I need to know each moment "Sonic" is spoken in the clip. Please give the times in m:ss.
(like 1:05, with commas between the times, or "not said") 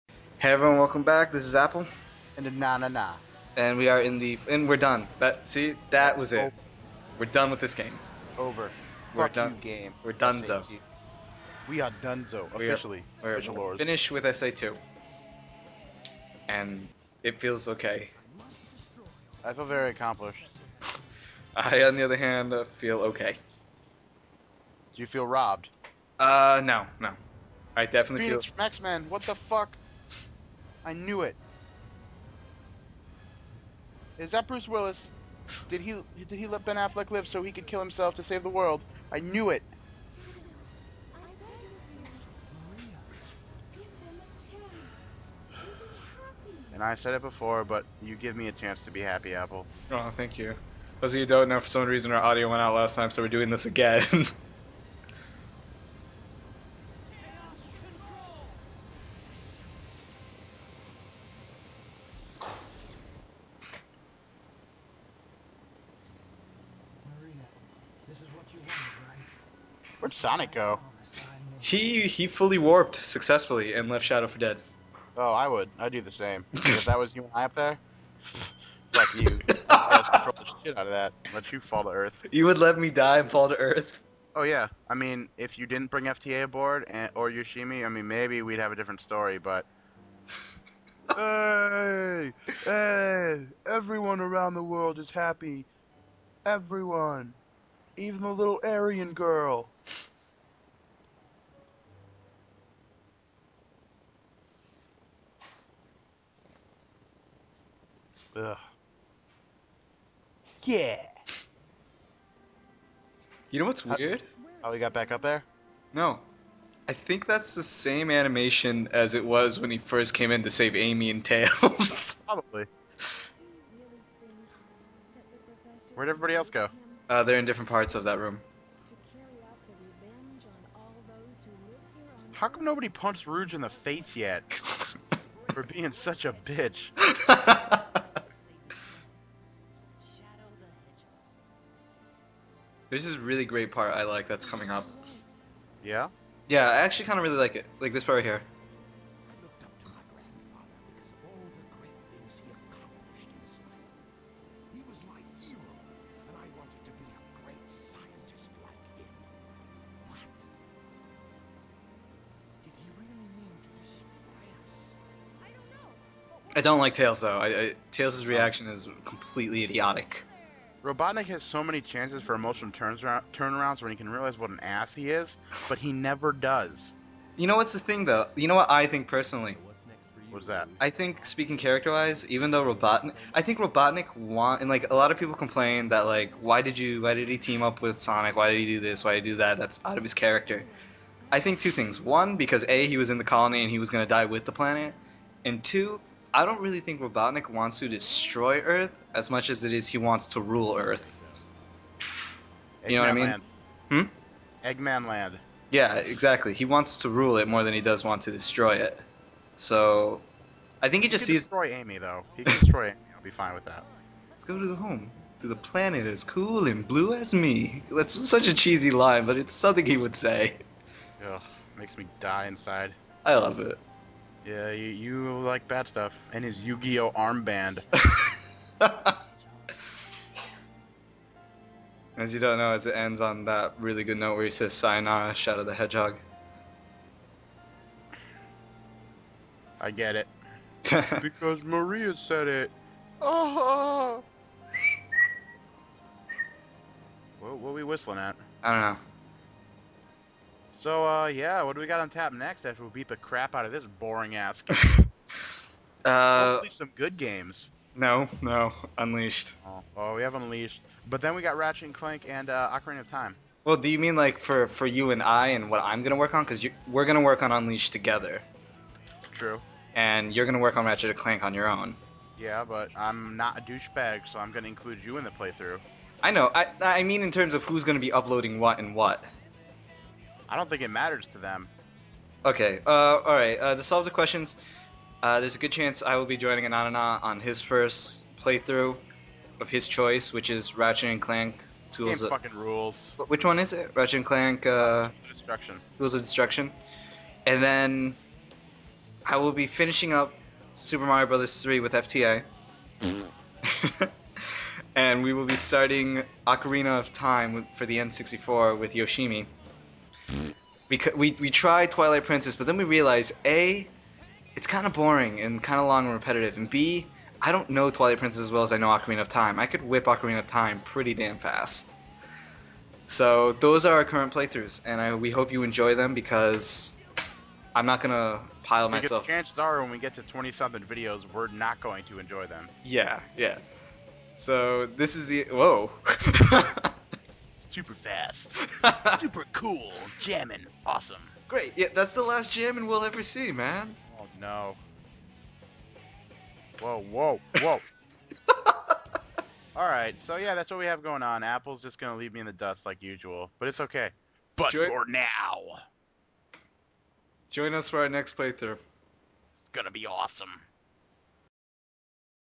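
1:10, 3:07.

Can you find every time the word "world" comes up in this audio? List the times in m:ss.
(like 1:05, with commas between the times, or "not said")
0:38, 1:34.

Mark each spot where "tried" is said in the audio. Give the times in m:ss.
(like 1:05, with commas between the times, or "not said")
5:11.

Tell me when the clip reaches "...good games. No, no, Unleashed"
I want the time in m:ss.
4:16.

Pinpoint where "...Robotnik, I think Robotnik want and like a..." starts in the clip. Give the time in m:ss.
3:02.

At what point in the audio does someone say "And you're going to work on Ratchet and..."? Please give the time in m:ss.
4:29.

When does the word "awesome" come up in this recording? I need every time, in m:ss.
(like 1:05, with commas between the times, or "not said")
5:40, 6:00.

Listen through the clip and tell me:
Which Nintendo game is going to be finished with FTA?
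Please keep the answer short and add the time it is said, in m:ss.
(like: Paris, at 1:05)
Super Mario Brothers 3, at 5:00.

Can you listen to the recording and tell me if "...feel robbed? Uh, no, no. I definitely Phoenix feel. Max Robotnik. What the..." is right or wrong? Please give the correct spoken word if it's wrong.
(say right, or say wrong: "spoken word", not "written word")
wrong: "Man", not "Robotnik".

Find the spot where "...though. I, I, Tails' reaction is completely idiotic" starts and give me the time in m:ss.
2:47.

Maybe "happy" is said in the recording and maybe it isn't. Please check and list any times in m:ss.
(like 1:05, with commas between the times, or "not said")
0:49, 1:35.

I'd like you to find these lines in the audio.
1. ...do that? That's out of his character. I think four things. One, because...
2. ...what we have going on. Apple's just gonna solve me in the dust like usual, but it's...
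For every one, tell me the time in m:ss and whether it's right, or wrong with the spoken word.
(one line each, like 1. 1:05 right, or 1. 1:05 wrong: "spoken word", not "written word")
1. 3:09 wrong: "two", not "four"
2. 5:50 wrong: "leave", not "solve".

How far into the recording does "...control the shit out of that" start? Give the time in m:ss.
1:20.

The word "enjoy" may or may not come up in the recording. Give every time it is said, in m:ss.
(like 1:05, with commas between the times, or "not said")
5:25, 5:32.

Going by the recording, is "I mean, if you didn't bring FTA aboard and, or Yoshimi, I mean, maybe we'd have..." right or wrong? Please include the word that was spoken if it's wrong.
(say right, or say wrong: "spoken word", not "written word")
right.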